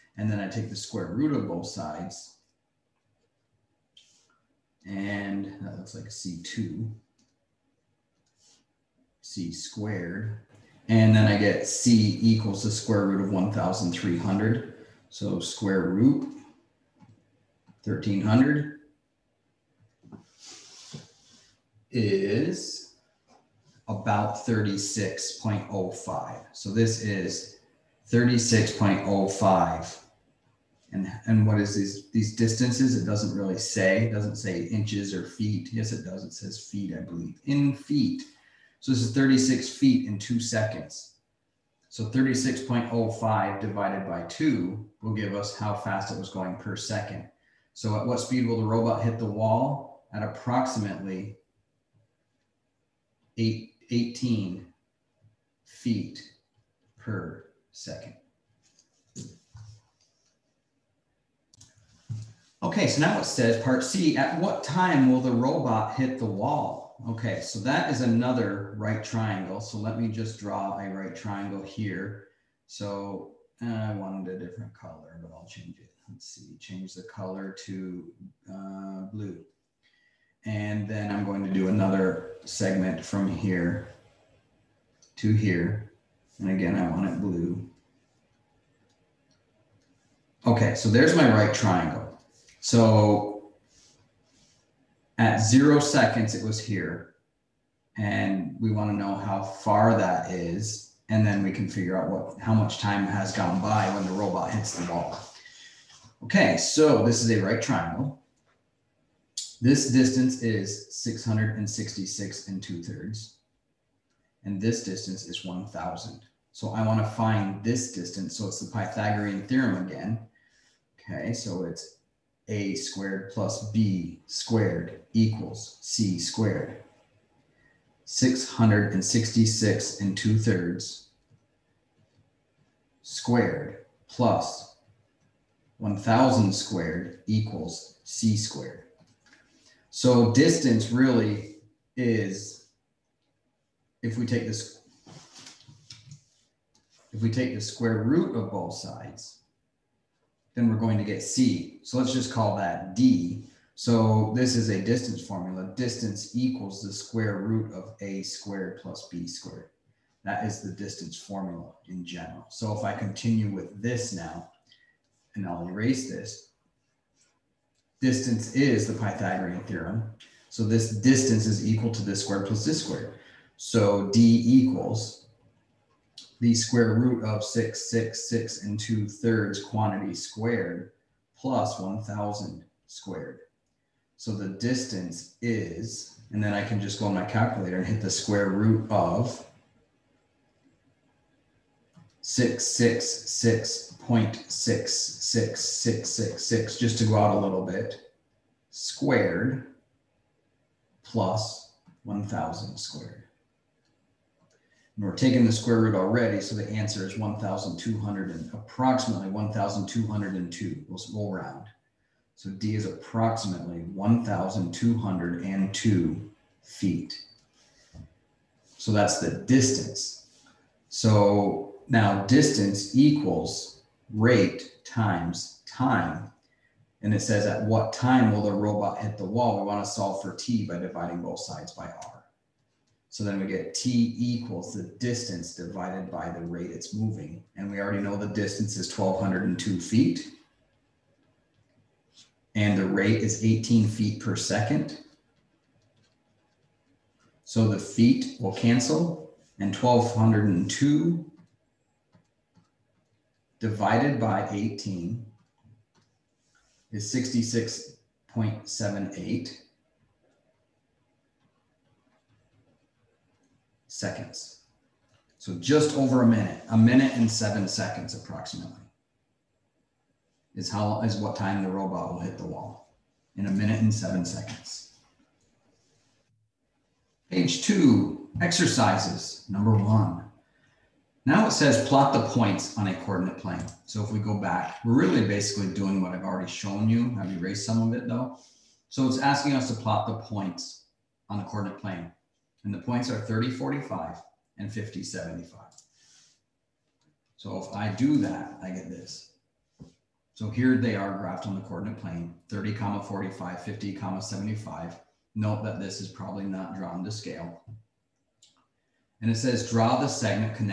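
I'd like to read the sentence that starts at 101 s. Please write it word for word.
And then we can figure out what how much time has gone by when the robot hits the wall.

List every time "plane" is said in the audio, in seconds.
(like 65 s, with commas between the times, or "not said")
283 s, 291 s, 301 s.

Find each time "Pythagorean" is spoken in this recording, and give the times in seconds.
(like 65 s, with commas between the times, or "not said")
118 s, 168 s.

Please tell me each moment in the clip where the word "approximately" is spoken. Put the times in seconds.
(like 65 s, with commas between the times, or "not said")
50 s, 208 s, 212 s, 268 s.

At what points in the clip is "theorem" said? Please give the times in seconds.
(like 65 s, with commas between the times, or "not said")
119 s, 169 s.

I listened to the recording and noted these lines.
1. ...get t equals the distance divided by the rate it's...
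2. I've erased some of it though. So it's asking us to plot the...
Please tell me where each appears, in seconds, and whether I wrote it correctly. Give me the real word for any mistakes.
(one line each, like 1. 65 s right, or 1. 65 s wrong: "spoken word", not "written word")
1. 233 s right
2. 287 s right.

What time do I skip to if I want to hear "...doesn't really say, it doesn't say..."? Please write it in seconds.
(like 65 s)
33 s.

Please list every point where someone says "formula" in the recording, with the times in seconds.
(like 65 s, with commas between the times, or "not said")
155 s, 161 s.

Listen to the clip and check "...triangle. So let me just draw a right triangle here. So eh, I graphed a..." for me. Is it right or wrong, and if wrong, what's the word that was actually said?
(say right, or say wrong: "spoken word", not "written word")
wrong: "wanted", not "graphed".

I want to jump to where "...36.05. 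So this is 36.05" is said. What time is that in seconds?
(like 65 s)
24 s.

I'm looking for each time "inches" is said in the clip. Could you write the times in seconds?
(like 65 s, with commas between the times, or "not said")
34 s.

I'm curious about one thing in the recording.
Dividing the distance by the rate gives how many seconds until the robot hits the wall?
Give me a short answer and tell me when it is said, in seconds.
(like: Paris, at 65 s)
66.78 seconds, at 257 s.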